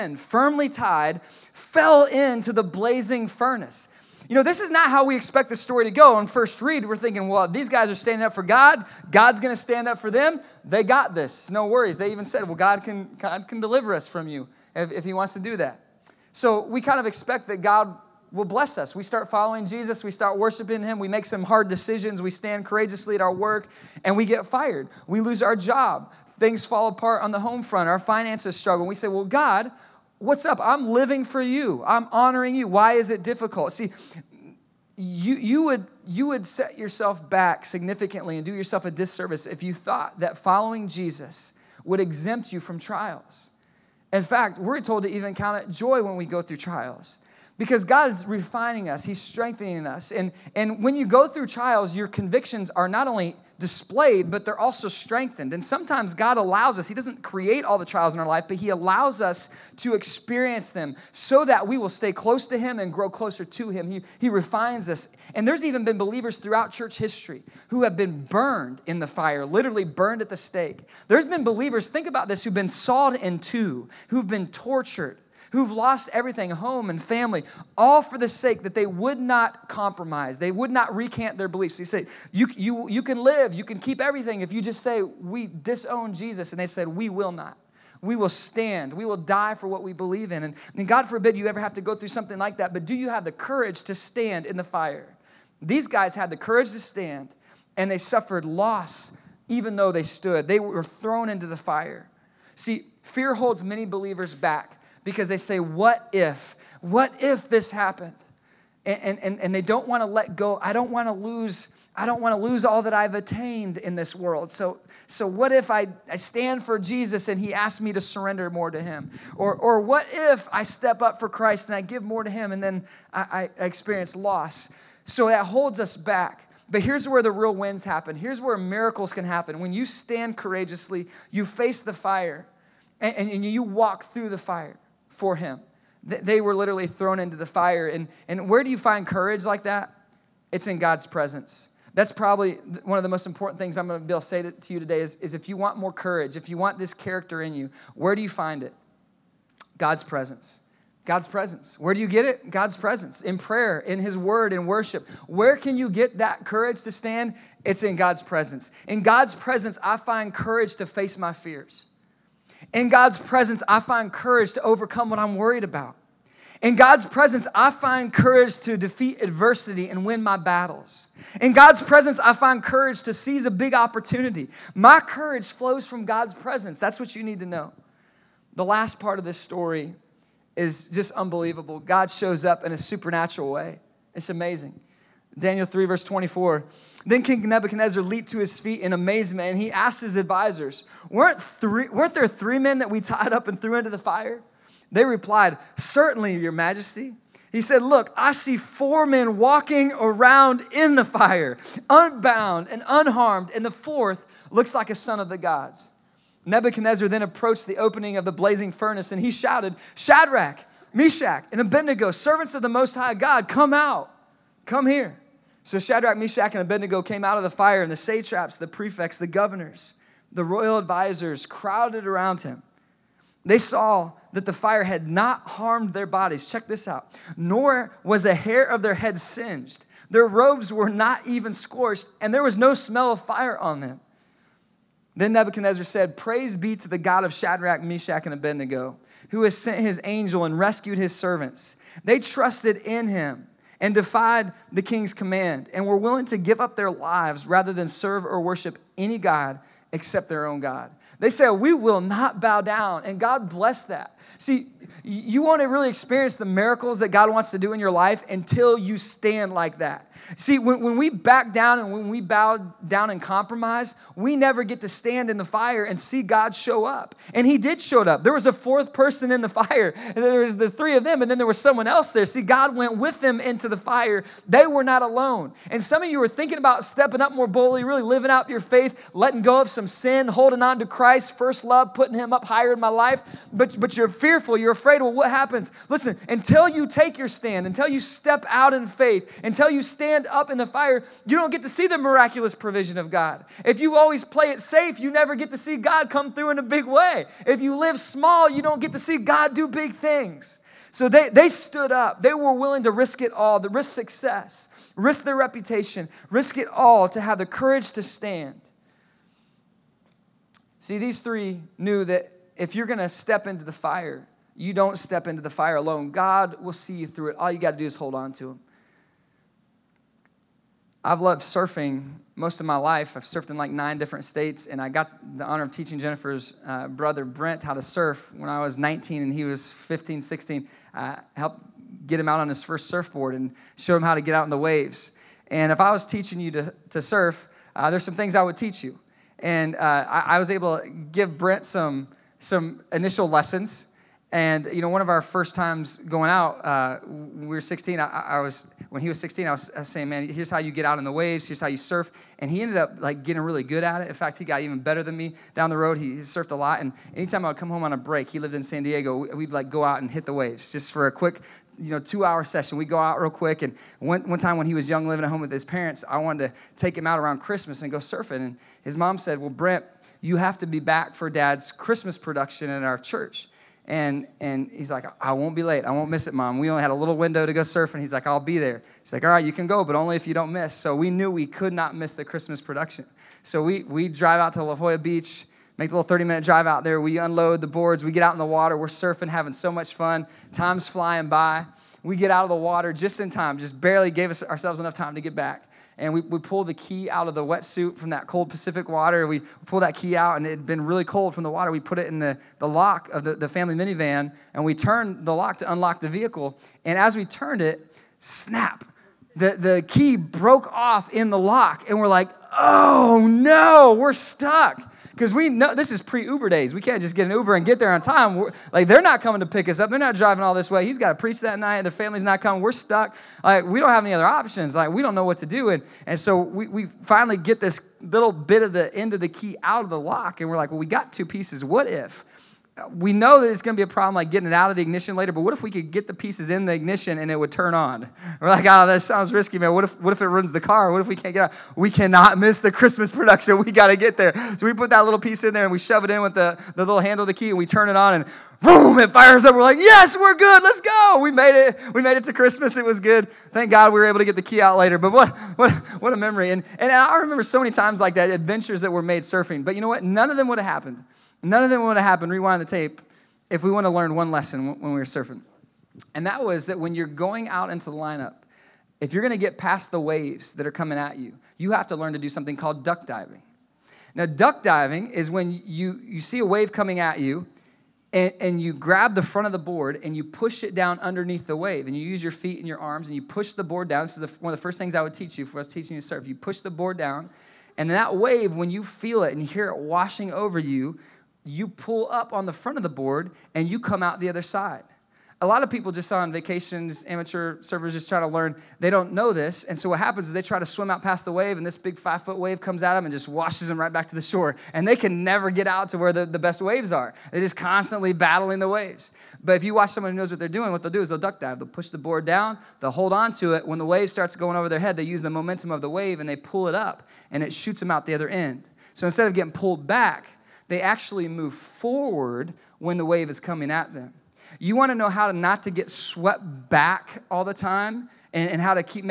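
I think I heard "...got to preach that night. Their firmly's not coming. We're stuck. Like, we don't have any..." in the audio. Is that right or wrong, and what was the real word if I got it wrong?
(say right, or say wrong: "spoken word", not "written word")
wrong: "family", not "firmly".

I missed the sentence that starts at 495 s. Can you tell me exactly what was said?
A lot of people just on vacations, amateur surfers just trying to learn.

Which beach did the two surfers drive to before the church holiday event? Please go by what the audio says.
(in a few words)
La Jolla Beach.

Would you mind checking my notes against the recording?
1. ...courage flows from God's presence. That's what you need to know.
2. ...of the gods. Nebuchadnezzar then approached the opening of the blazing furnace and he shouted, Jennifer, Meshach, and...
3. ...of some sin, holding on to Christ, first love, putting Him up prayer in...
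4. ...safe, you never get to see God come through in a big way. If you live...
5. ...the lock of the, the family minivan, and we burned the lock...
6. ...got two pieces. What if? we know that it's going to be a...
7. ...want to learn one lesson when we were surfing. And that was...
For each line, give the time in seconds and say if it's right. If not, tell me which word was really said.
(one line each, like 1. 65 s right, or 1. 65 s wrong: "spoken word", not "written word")
1. 174 s right
2. 205 s wrong: "Shadrach", not "Jennifer"
3. 279 s wrong: "higher", not "prayer"
4. 294 s right
5. 402 s wrong: "turned", not "burned"
6. 430 s right
7. 463 s right.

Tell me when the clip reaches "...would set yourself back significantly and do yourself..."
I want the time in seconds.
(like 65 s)
36 s.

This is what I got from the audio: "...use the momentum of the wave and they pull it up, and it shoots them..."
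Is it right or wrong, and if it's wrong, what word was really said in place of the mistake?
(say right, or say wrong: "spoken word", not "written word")
right.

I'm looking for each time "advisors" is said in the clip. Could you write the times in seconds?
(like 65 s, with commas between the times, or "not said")
190 s, 220 s.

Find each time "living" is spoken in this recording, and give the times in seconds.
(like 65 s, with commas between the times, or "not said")
30 s, 278 s, 365 s.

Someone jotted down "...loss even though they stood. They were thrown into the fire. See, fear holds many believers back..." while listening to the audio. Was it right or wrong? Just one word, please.
right.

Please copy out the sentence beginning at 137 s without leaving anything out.
And, and where do you find courage like that?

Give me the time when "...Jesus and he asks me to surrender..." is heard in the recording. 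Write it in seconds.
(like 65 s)
116 s.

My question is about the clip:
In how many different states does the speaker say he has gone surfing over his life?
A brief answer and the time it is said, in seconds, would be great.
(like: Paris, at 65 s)
9, at 323 s.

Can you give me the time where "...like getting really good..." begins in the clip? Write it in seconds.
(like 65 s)
352 s.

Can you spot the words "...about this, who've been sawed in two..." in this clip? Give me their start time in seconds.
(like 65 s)
72 s.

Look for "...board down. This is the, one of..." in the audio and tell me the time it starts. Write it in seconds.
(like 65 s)
483 s.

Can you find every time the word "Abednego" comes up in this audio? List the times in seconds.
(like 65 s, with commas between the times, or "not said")
211 s, 216 s, 238 s.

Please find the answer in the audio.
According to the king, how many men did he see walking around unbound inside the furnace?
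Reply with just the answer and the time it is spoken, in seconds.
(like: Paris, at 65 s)
4, at 198 s.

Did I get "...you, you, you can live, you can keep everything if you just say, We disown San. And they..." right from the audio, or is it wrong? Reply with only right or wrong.
wrong.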